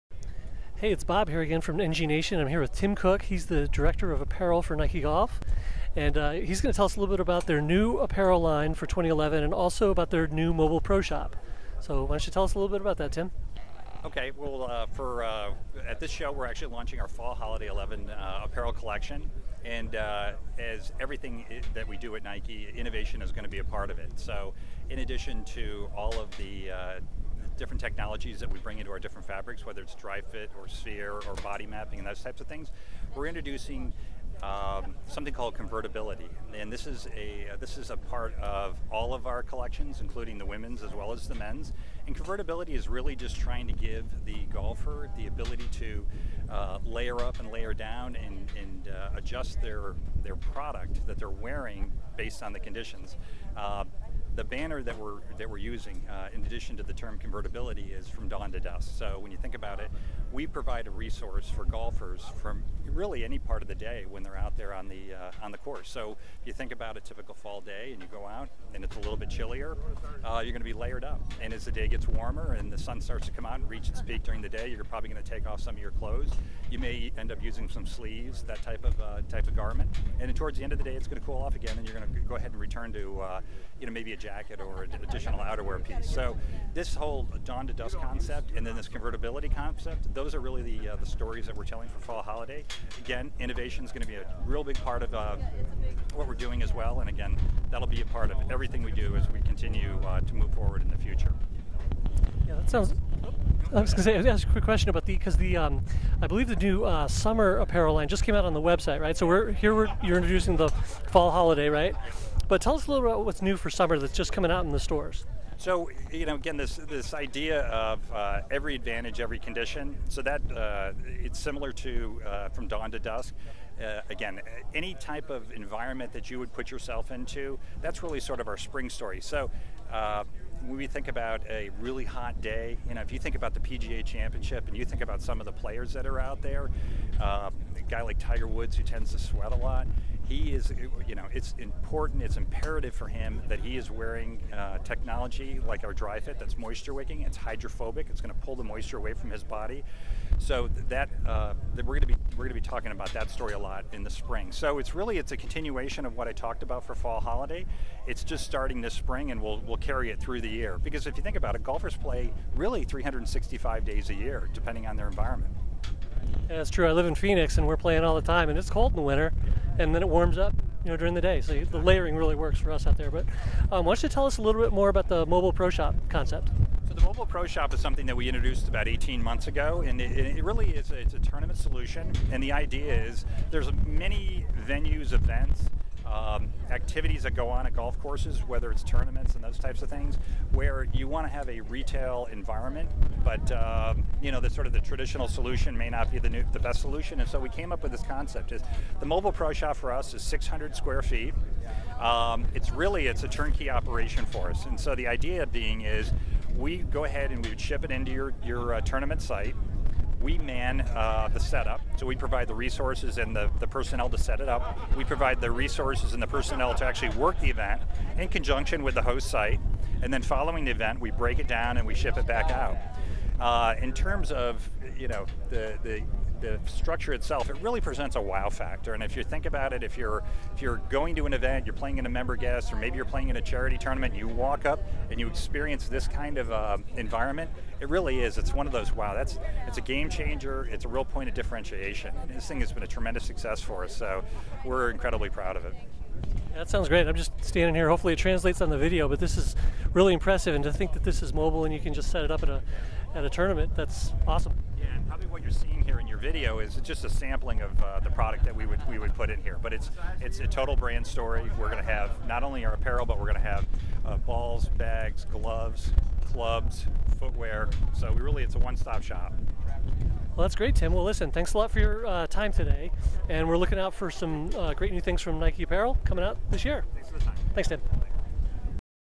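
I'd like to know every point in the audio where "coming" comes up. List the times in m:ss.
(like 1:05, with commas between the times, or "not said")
1:54, 4:36.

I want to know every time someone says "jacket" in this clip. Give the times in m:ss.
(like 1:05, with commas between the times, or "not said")
1:24.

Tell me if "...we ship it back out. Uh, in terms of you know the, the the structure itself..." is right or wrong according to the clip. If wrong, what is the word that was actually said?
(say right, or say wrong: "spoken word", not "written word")
right.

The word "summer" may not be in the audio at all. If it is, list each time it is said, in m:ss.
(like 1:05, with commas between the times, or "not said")
1:47, 1:53.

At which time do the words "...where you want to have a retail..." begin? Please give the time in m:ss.
3:10.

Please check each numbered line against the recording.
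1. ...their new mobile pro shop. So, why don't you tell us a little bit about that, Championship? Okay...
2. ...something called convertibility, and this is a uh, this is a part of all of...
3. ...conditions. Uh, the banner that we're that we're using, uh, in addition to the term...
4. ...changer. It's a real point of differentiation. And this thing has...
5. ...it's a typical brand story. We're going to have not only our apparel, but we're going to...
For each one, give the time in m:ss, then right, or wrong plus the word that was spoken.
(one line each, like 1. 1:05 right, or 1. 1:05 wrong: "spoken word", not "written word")
1. 0:10 wrong: "Tim", not "Championship"
2. 0:35 right
3. 0:52 right
4. 4:00 right
5. 4:20 wrong: "total", not "typical".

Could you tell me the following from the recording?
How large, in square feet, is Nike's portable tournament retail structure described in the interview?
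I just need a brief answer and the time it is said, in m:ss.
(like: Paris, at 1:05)
600 square feet, at 3:20.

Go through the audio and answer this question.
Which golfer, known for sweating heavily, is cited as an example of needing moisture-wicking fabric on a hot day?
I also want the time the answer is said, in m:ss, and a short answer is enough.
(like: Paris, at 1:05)
Tiger Woods, at 2:18.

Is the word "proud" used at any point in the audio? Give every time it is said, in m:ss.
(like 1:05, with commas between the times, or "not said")
4:05.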